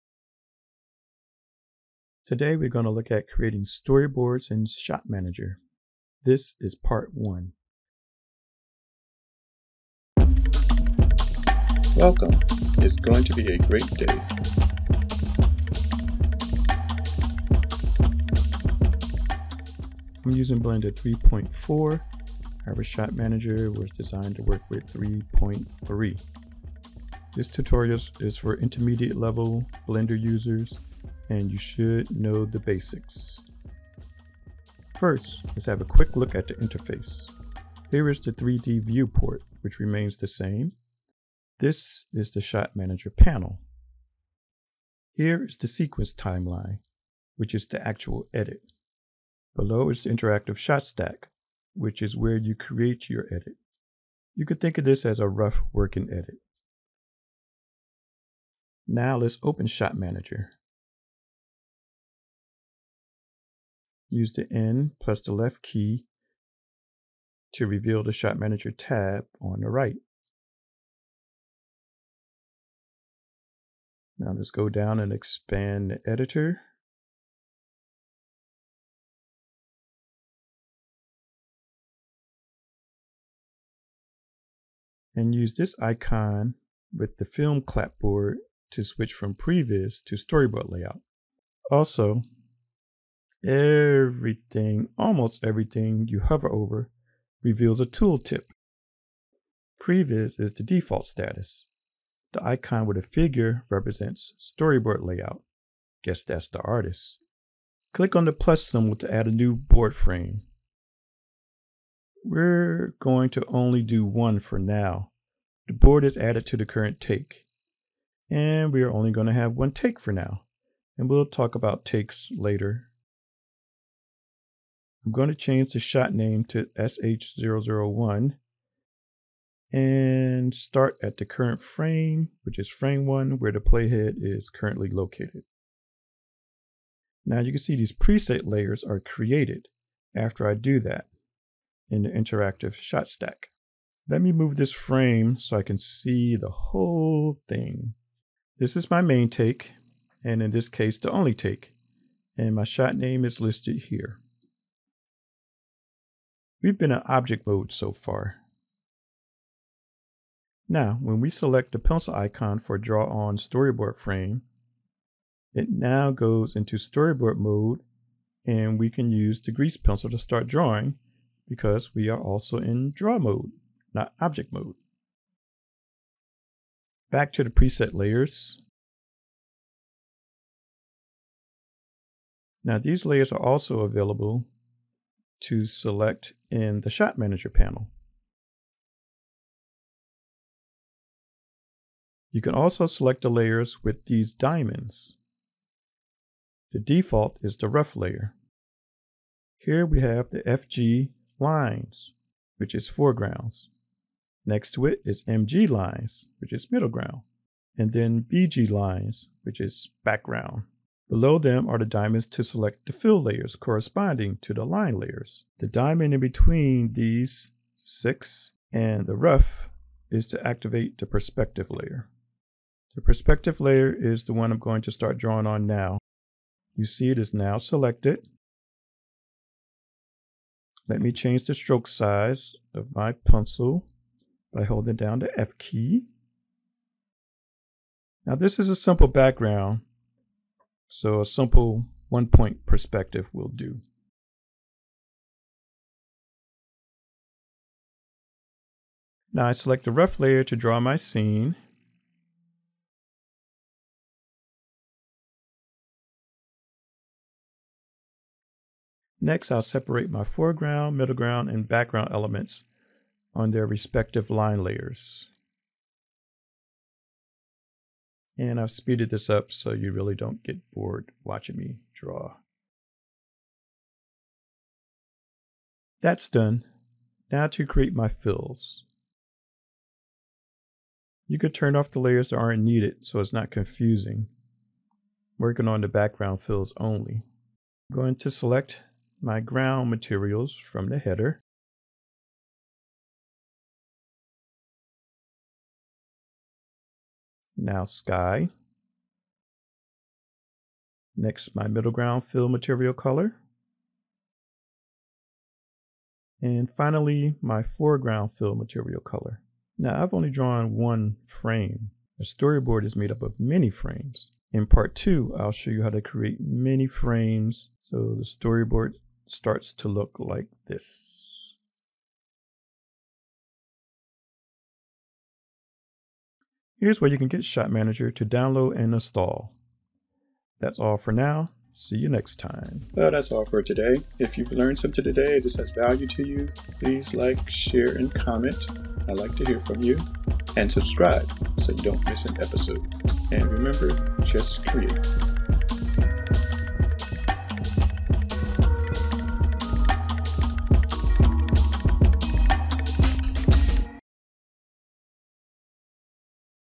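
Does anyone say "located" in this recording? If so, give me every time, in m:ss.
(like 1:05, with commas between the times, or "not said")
2:14.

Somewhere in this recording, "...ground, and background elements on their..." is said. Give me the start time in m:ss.
4:21.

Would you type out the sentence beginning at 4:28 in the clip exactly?
And I've speeded this up so you really don't get bored watching me draw.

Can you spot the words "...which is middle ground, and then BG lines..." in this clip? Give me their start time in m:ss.
3:26.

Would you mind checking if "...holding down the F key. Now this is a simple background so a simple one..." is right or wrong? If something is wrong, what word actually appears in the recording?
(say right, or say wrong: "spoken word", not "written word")
right.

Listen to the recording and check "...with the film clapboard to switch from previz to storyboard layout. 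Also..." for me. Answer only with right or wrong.
right.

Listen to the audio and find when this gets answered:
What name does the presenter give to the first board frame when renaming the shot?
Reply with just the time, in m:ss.
2:06.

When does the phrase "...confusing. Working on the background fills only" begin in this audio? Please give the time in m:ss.
4:43.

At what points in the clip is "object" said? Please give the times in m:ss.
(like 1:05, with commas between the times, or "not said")
2:37, 2:54.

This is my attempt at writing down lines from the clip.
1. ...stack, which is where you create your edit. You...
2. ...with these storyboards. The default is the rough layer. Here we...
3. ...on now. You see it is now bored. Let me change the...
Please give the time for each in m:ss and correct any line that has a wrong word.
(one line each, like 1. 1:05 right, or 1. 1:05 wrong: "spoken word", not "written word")
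1. 0:50 right
2. 3:13 wrong: "diamonds", not "storyboards"
3. 3:45 wrong: "selected", not "bored".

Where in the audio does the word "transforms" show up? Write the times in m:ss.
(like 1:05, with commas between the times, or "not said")
not said.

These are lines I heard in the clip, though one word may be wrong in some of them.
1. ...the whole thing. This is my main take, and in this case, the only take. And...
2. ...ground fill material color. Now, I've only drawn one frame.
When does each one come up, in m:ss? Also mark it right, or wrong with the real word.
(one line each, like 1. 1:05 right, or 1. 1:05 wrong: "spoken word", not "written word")
1. 2:26 right
2. 5:07 wrong: "foreground", not "ground".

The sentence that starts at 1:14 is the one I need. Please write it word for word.
Now let's go down and expand the editor.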